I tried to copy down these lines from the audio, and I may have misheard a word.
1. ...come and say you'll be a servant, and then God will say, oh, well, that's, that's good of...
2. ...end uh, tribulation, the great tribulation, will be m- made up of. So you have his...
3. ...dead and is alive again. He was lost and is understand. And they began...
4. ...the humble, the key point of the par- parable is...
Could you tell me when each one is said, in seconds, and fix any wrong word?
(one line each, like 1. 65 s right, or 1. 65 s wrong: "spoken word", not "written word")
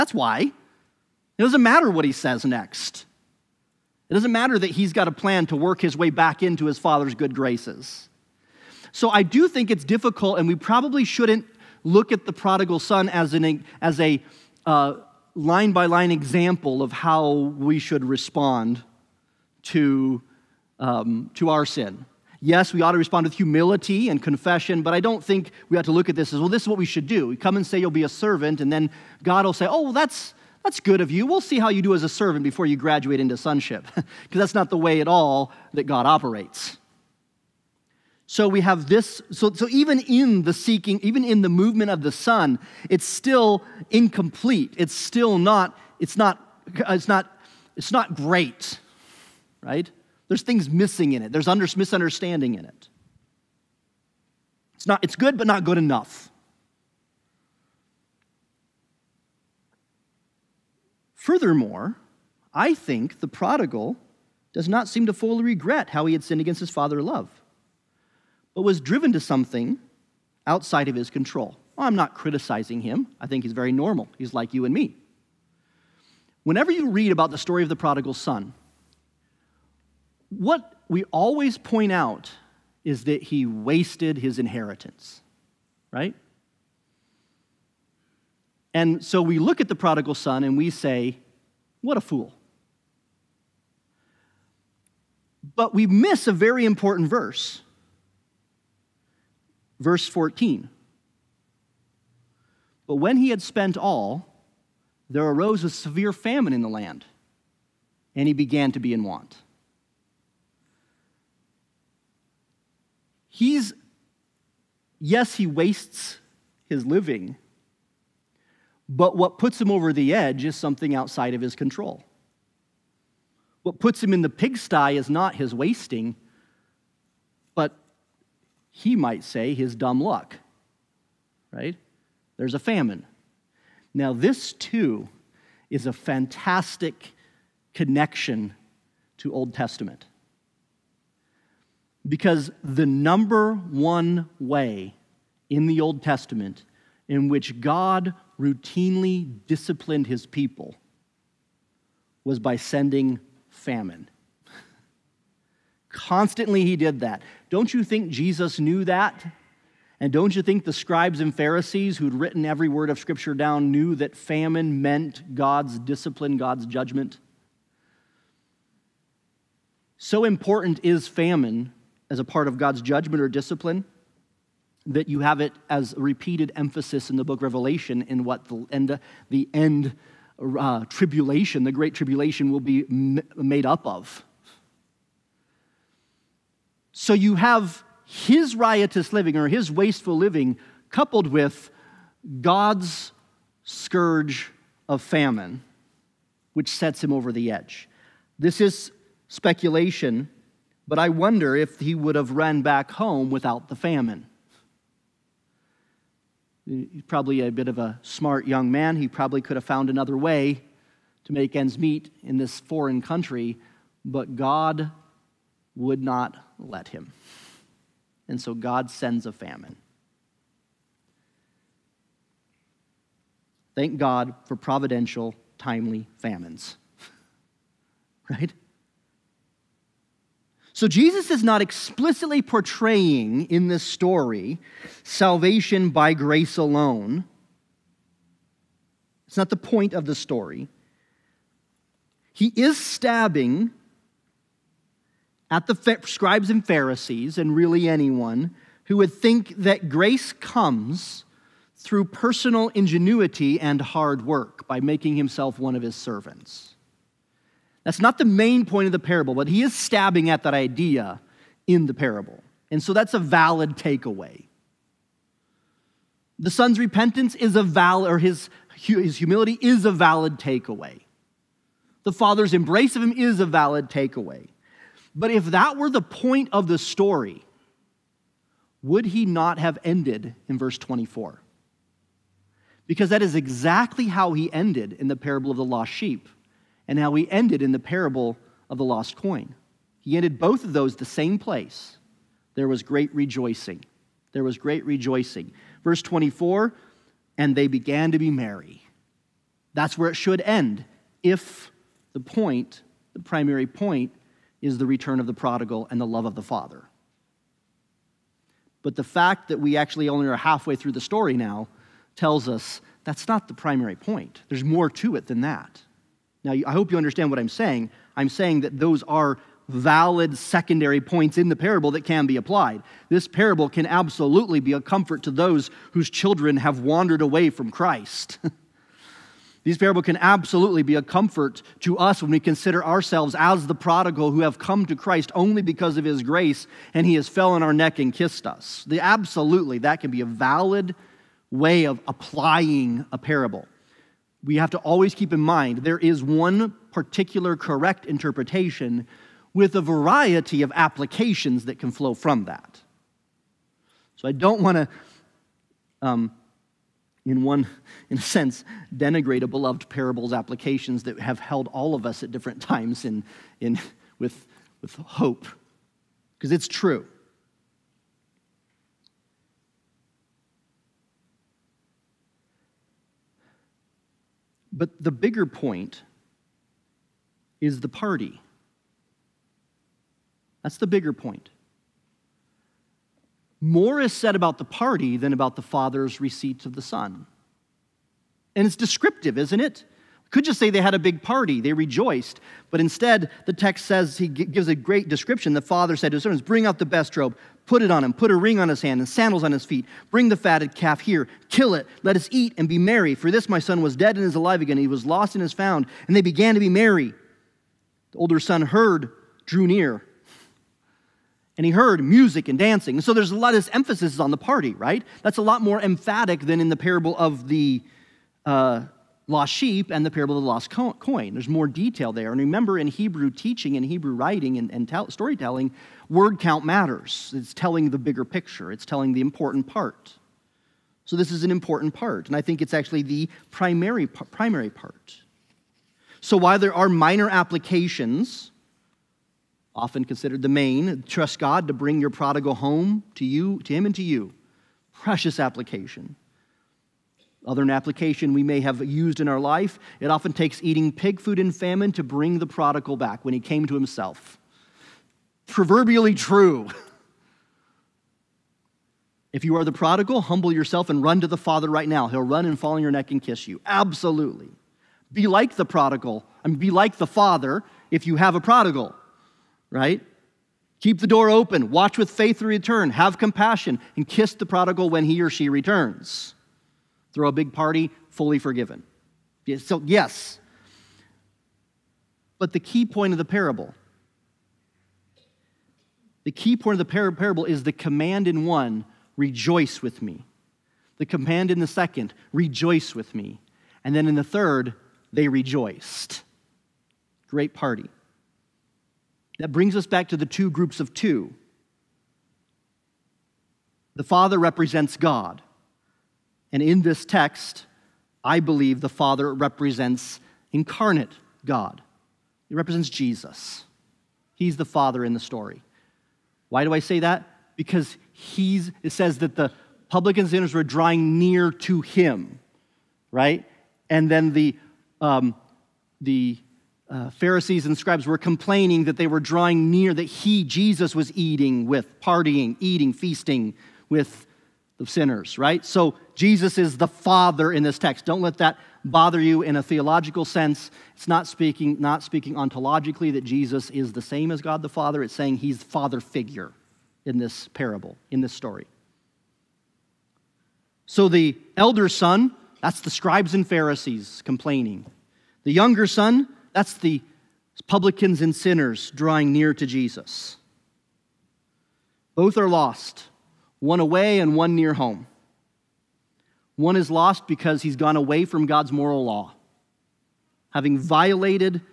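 1. 27 s right
2. 179 s right
3. 403 s wrong: "found", not "understand"
4. 483 s wrong: "parable", not "humble".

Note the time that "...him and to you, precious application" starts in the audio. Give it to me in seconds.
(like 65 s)
443 s.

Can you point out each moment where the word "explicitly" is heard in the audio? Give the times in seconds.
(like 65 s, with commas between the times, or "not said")
231 s.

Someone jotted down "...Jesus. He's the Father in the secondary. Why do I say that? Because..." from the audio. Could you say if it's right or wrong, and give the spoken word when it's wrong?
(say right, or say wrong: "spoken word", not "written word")
wrong: "story", not "secondary".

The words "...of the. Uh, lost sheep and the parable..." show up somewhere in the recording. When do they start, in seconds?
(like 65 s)
417 s.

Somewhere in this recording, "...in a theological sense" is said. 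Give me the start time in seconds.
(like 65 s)
539 s.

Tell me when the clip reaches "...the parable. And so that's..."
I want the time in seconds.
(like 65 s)
261 s.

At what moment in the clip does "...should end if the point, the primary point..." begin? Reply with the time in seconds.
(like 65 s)
300 s.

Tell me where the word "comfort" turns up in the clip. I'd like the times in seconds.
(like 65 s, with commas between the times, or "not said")
324 s, 331 s.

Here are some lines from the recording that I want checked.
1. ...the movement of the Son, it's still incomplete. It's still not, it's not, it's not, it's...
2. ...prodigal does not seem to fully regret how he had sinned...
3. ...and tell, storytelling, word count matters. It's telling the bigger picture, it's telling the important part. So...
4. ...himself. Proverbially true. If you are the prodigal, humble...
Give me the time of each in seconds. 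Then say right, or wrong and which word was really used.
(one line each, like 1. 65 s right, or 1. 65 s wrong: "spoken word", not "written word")
1. 41 s right
2. 63 s right
3. 424 s right
4. 453 s right.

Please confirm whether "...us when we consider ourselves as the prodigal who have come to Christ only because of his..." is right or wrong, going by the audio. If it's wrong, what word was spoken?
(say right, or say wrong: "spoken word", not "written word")
right.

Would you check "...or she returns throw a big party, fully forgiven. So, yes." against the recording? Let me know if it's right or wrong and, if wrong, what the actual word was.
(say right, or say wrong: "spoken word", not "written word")
right.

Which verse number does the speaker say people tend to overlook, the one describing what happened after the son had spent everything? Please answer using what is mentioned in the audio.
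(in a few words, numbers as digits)
verse 14.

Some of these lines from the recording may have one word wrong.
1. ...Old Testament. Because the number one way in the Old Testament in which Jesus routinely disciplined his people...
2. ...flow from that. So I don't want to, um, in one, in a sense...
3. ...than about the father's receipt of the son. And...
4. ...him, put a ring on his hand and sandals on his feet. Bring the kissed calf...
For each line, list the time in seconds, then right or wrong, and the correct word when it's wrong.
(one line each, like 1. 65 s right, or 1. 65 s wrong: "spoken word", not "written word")
1. 139 s wrong: "God", not "Jesus"
2. 351 s right
3. 385 s right
4. 398 s wrong: "fatted", not "kissed".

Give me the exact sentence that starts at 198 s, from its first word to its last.
This is speculation, but I wonder if he would have run back home without the famine.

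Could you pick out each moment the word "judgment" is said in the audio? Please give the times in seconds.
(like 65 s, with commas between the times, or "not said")
166 s, 172 s.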